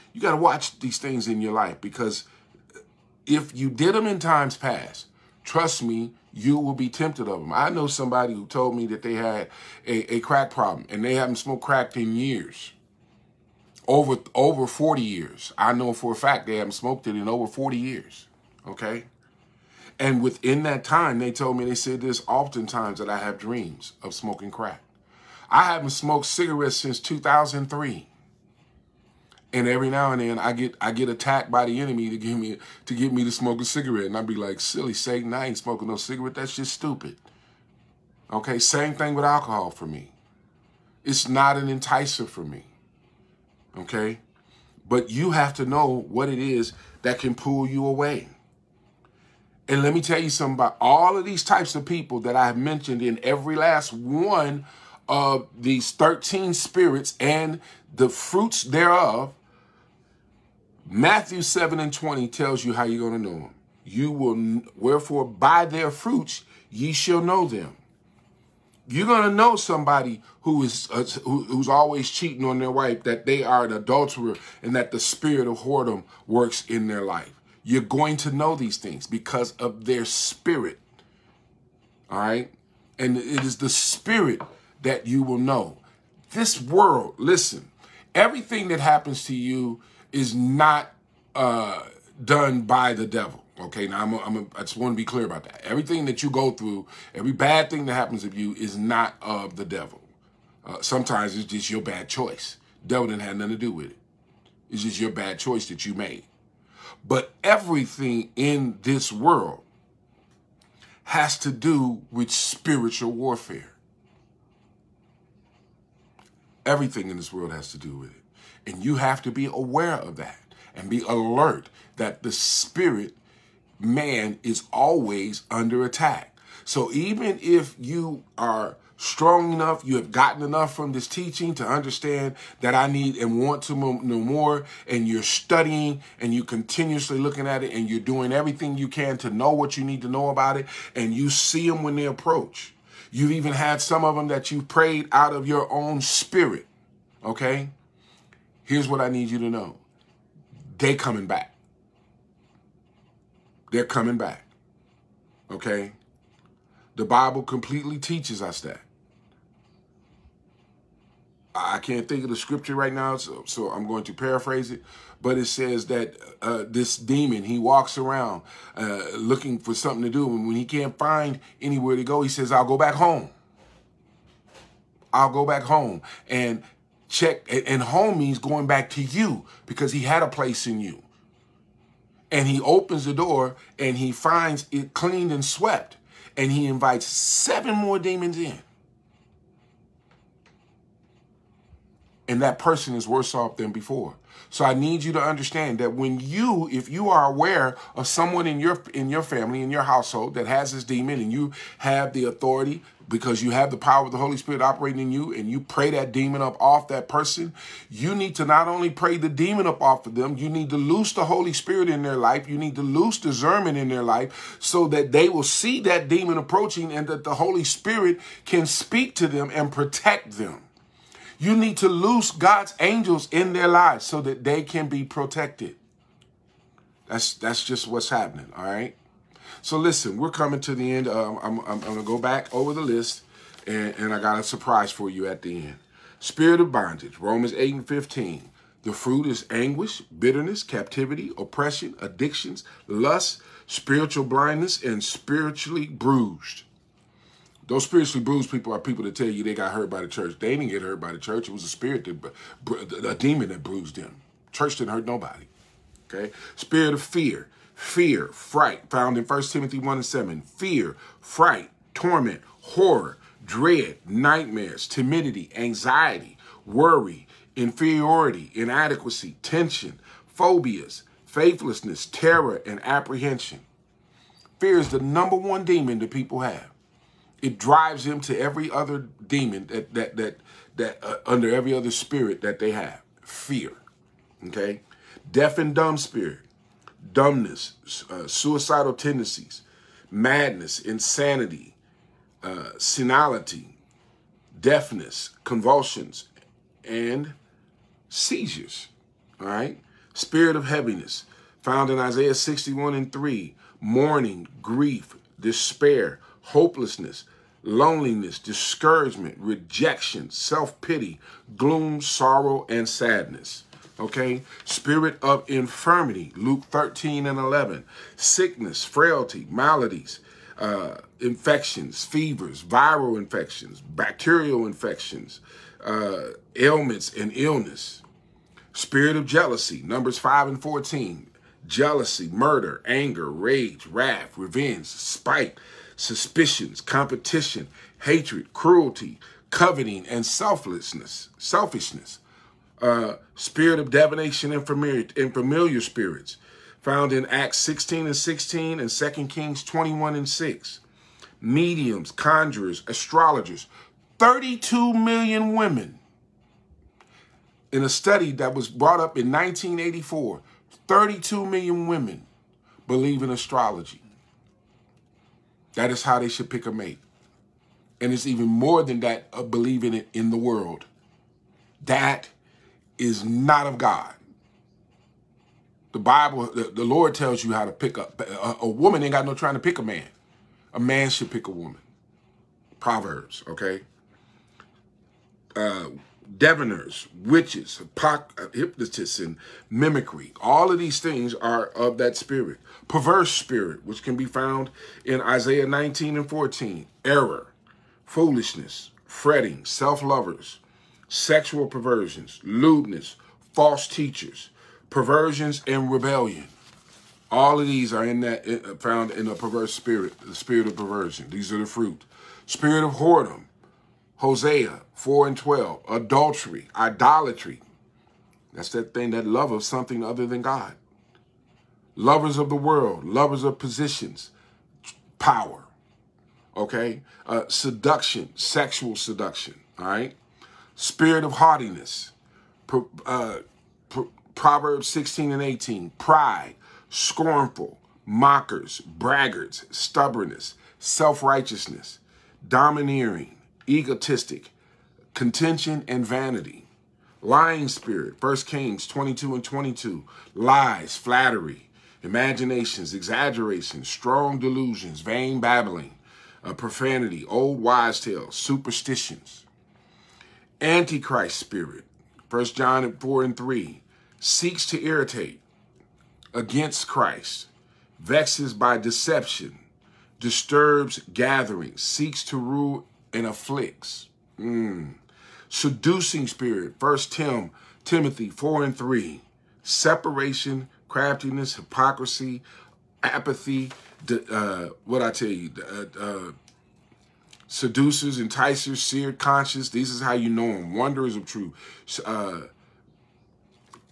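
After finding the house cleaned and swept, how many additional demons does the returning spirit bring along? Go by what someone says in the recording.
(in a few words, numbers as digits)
7.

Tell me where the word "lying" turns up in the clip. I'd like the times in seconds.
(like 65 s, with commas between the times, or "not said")
447 s.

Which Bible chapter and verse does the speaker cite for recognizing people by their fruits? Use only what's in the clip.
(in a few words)
Matthew 7:20.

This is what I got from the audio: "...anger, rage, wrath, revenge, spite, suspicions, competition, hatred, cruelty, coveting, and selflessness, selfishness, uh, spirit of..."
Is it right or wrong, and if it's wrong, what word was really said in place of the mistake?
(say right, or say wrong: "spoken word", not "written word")
right.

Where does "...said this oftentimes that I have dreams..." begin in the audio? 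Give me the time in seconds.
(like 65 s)
21 s.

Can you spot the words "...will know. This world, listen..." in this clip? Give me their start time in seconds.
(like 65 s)
85 s.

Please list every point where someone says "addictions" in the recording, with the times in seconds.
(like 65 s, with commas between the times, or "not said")
242 s.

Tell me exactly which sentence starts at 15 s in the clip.
I know for a fact they haven't smoked it in over 40 years.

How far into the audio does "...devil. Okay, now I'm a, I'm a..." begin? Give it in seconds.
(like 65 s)
93 s.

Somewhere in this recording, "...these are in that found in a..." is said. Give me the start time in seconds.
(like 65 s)
407 s.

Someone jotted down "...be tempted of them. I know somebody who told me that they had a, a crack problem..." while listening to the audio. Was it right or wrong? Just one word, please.
right.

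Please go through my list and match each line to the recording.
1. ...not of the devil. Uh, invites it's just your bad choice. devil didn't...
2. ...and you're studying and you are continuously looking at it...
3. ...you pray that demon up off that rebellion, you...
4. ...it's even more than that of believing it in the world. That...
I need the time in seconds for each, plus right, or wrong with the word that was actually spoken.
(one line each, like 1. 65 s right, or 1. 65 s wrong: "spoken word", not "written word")
1. 98 s wrong: "sometimes", not "invites"
2. 134 s right
3. 205 s wrong: "person", not "rebellion"
4. 368 s right.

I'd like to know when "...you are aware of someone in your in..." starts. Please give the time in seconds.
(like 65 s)
196 s.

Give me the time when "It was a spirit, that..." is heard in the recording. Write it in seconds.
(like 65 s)
251 s.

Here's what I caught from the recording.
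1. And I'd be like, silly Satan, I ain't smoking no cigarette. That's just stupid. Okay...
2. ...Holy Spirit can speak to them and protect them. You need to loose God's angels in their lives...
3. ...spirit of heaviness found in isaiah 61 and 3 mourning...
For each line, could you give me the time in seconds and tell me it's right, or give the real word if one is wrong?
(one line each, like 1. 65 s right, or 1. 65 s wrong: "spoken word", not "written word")
1. 34 s right
2. 217 s right
3. 300 s right.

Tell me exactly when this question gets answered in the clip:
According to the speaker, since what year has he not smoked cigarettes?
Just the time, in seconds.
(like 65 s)
26 s.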